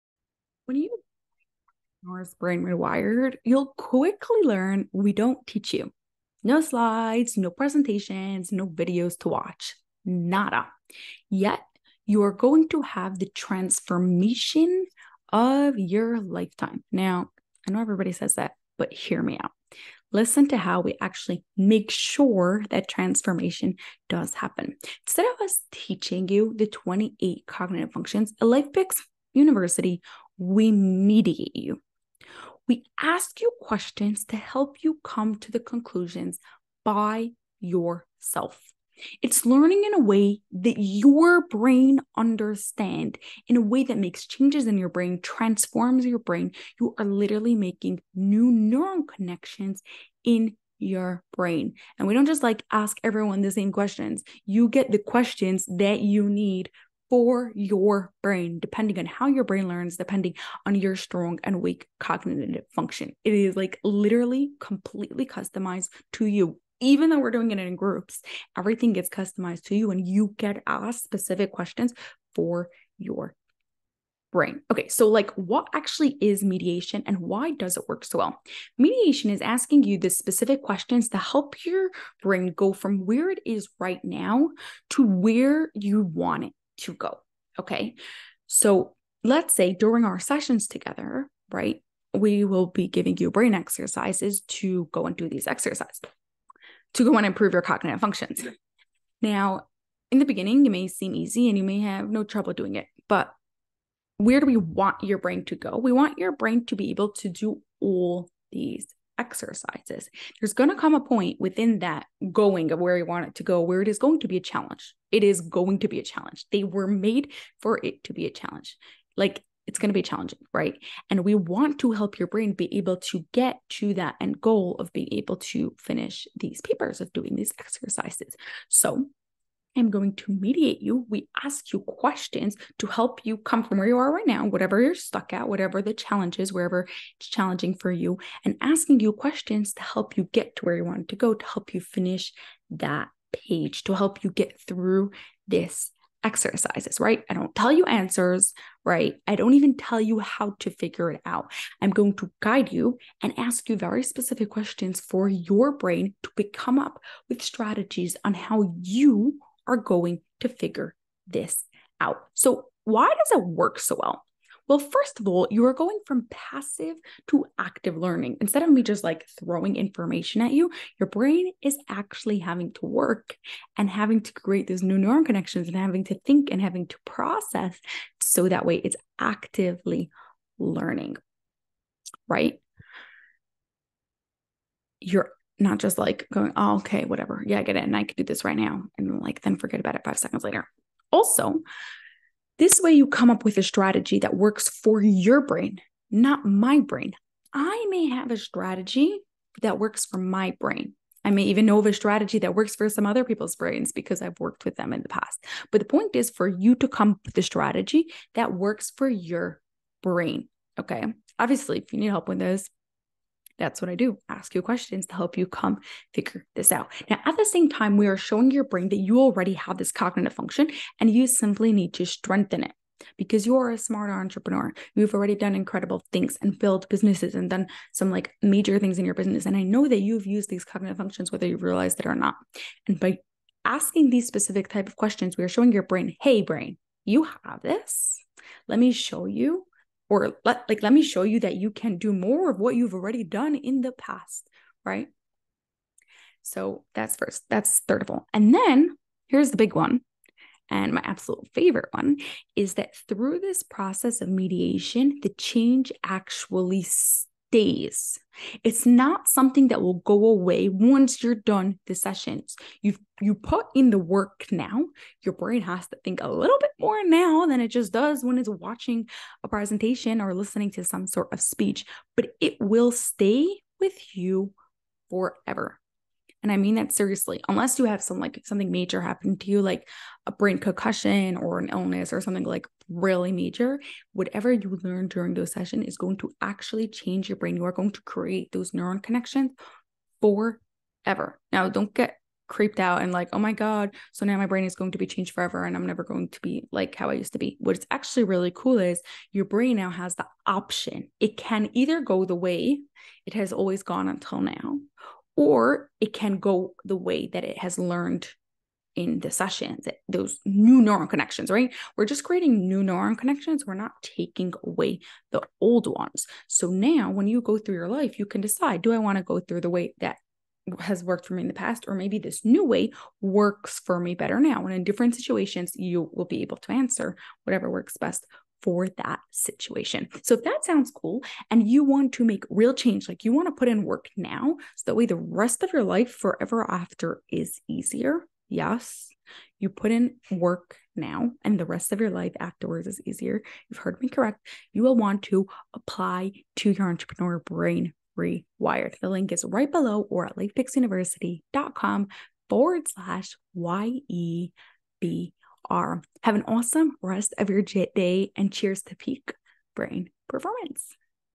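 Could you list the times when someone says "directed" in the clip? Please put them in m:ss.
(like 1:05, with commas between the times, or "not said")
not said.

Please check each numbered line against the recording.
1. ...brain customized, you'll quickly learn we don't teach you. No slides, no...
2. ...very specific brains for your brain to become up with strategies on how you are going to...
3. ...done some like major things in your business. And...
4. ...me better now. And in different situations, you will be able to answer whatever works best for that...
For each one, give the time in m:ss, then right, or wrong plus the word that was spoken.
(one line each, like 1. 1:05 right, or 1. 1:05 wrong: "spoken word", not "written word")
1. 0:02 wrong: "rewired", not "customized"
2. 2:33 wrong: "questions", not "brains"
3. 3:47 right
4. 5:23 right.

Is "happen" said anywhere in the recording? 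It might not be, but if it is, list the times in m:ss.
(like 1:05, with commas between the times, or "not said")
0:24, 4:39.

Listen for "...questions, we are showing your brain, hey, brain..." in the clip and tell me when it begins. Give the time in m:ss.
3:54.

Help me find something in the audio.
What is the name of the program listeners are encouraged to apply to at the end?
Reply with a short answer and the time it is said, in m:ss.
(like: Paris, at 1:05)
Entrepreneur Brain Rewired, at 5:46.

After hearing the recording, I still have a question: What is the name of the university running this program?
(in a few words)
LifePix University.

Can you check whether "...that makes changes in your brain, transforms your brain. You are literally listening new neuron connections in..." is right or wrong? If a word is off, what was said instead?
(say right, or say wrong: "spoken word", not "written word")
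wrong: "making", not "listening".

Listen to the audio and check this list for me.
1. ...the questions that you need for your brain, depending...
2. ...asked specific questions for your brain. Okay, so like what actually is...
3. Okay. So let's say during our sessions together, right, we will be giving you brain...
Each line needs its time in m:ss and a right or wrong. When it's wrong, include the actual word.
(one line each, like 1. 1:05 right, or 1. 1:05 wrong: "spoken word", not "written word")
1. 0:54 right
2. 1:10 right
3. 1:27 right.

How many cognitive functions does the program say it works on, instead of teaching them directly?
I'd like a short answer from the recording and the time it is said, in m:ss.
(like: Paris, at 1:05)
28, at 0:26.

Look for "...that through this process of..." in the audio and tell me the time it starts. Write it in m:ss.
4:12.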